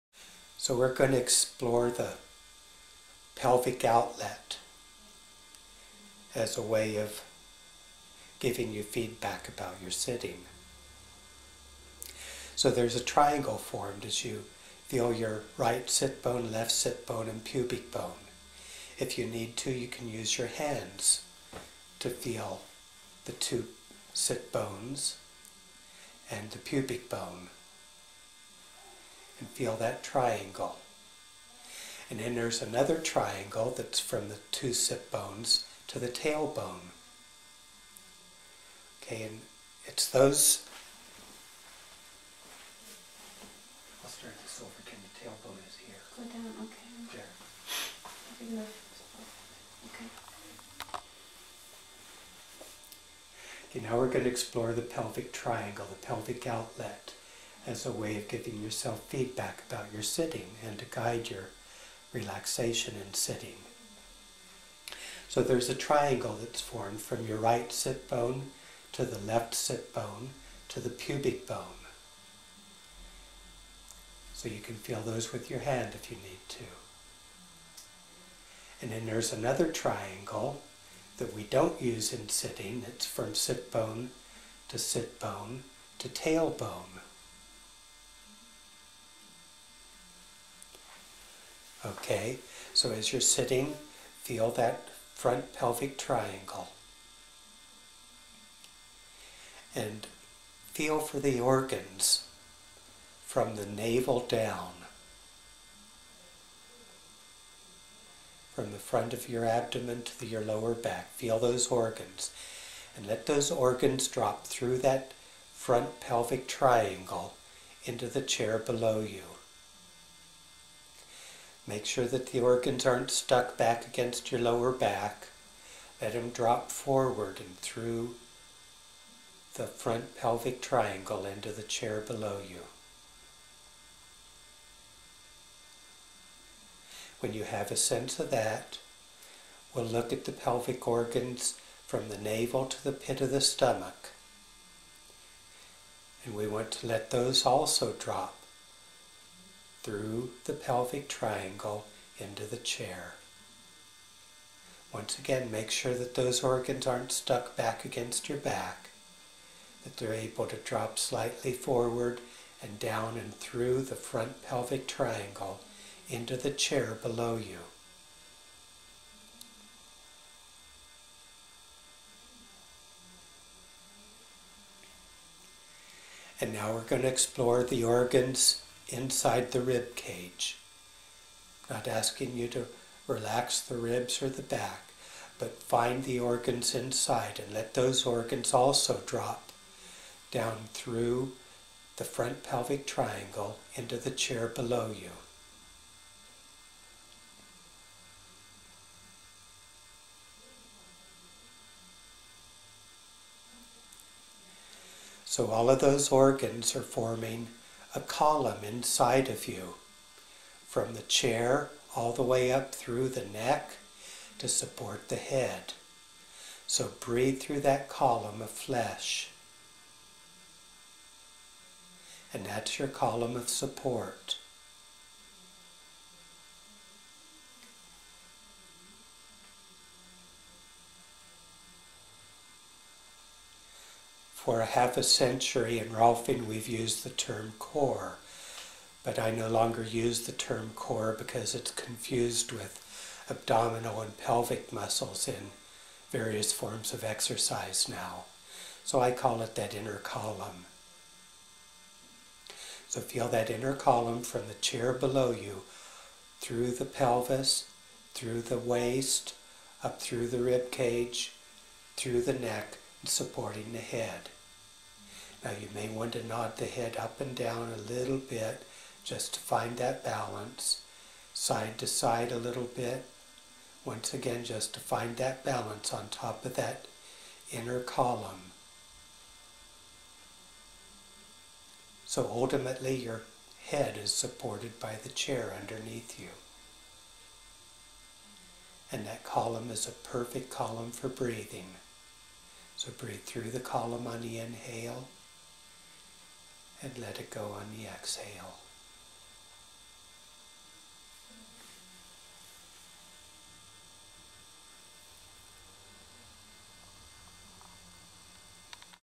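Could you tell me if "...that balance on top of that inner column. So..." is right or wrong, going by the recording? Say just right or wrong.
right.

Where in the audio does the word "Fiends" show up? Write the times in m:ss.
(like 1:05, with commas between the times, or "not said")
not said.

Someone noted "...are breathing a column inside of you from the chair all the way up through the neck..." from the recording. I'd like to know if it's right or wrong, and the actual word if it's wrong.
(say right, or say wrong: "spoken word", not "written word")
wrong: "forming", not "breathing".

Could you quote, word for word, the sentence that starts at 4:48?
And that column is a perfect column for breathing.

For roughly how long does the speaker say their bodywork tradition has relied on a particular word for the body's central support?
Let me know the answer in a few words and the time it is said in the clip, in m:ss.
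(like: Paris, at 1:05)
Half a century, at 3:54.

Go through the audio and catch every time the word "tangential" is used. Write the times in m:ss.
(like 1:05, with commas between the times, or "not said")
not said.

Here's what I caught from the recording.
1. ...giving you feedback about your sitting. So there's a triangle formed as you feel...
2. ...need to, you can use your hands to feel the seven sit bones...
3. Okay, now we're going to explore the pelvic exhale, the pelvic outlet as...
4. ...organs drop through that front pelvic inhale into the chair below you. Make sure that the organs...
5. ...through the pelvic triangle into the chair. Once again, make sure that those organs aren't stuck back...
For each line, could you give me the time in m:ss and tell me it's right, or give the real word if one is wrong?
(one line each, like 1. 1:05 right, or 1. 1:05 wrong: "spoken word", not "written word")
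1. 0:08 right
2. 0:19 wrong: "two", not "seven"
3. 0:53 wrong: "triangle", not "exhale"
4. 1:53 wrong: "triangle", not "inhale"
5. 2:29 right.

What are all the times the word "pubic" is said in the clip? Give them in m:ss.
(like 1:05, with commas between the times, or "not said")
0:17, 0:26, 1:10.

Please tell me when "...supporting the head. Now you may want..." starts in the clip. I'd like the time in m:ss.
4:23.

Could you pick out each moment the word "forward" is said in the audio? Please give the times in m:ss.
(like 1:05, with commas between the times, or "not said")
2:06, 2:41.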